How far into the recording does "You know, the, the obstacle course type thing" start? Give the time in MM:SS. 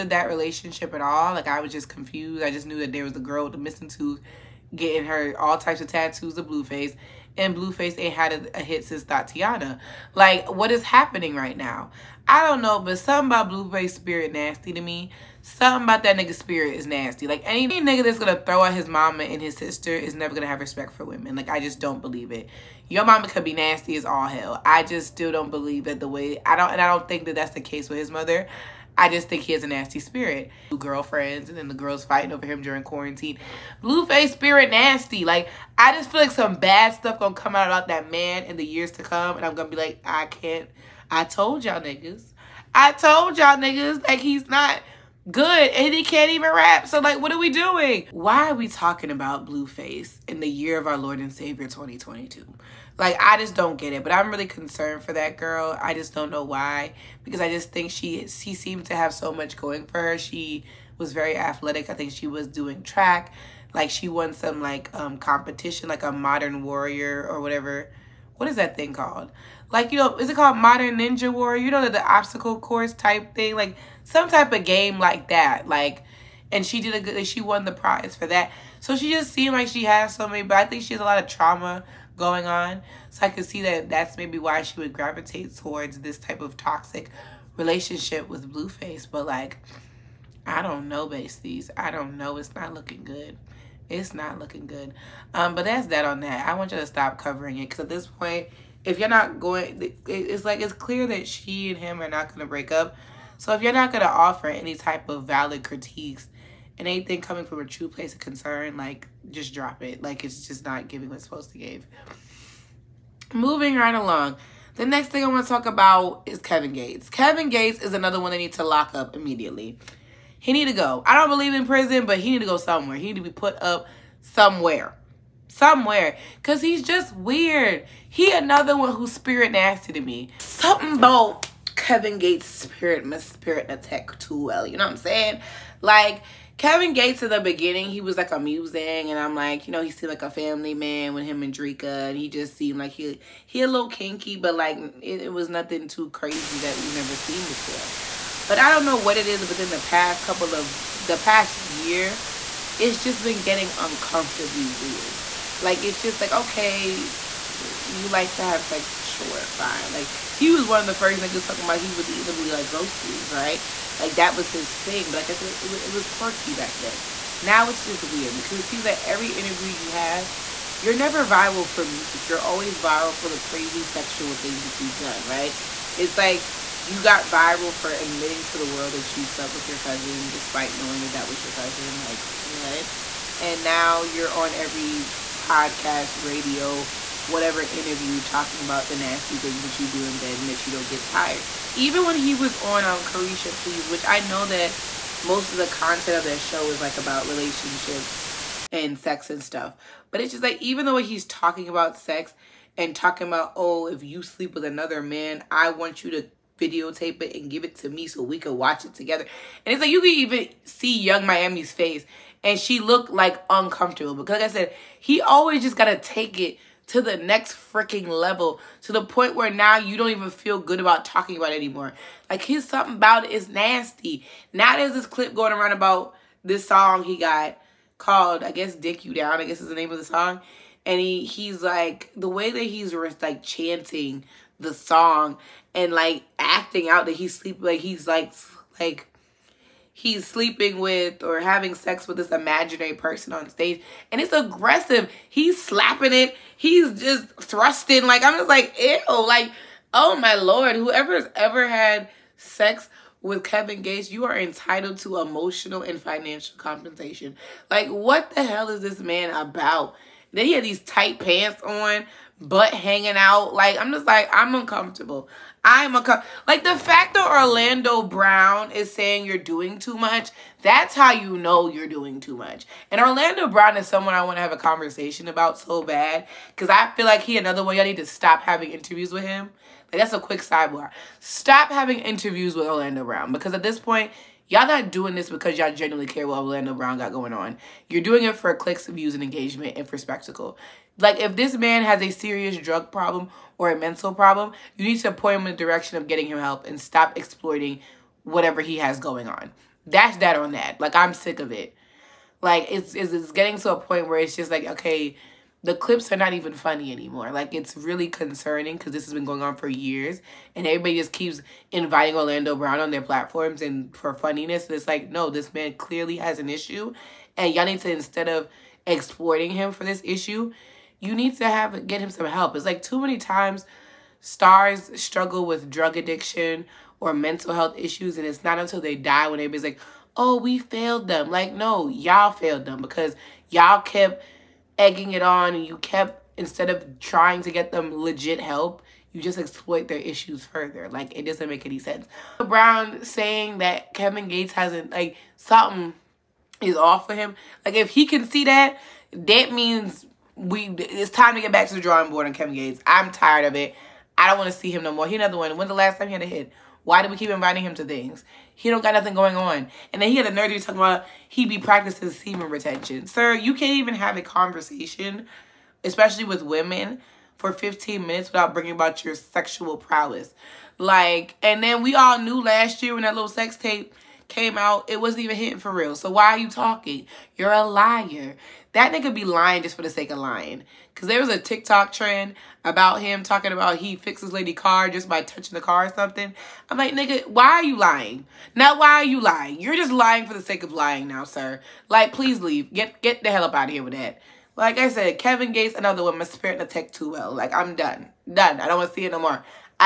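01:11.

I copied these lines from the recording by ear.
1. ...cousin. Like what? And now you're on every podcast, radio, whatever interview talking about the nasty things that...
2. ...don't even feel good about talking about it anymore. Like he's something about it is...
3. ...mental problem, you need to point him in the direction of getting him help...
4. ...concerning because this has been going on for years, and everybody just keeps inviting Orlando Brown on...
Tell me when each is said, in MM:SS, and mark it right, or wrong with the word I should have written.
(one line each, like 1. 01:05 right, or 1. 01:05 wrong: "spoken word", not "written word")
1. 03:01 right
2. 03:39 right
3. 04:53 right
4. 05:08 right.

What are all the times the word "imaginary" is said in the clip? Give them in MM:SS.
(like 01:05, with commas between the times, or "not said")
04:02.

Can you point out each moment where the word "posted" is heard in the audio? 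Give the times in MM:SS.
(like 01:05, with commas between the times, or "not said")
not said.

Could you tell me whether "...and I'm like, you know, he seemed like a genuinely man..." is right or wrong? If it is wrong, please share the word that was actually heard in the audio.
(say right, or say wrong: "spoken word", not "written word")
wrong: "family", not "genuinely".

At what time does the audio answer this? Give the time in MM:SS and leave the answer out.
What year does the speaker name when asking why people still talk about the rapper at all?
00:51.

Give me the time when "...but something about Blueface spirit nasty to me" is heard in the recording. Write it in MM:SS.
00:12.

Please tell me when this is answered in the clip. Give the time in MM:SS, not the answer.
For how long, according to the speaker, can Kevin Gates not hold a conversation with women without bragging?
06:07.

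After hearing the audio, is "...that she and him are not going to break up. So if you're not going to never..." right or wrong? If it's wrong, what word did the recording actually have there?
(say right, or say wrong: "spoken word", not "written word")
wrong: "offer", not "never".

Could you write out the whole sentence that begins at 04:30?
That's how you know you're doing too much.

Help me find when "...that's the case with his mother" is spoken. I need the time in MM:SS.
00:27.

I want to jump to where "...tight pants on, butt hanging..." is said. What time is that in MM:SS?
04:20.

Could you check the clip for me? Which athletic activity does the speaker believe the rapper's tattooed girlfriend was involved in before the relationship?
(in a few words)
track.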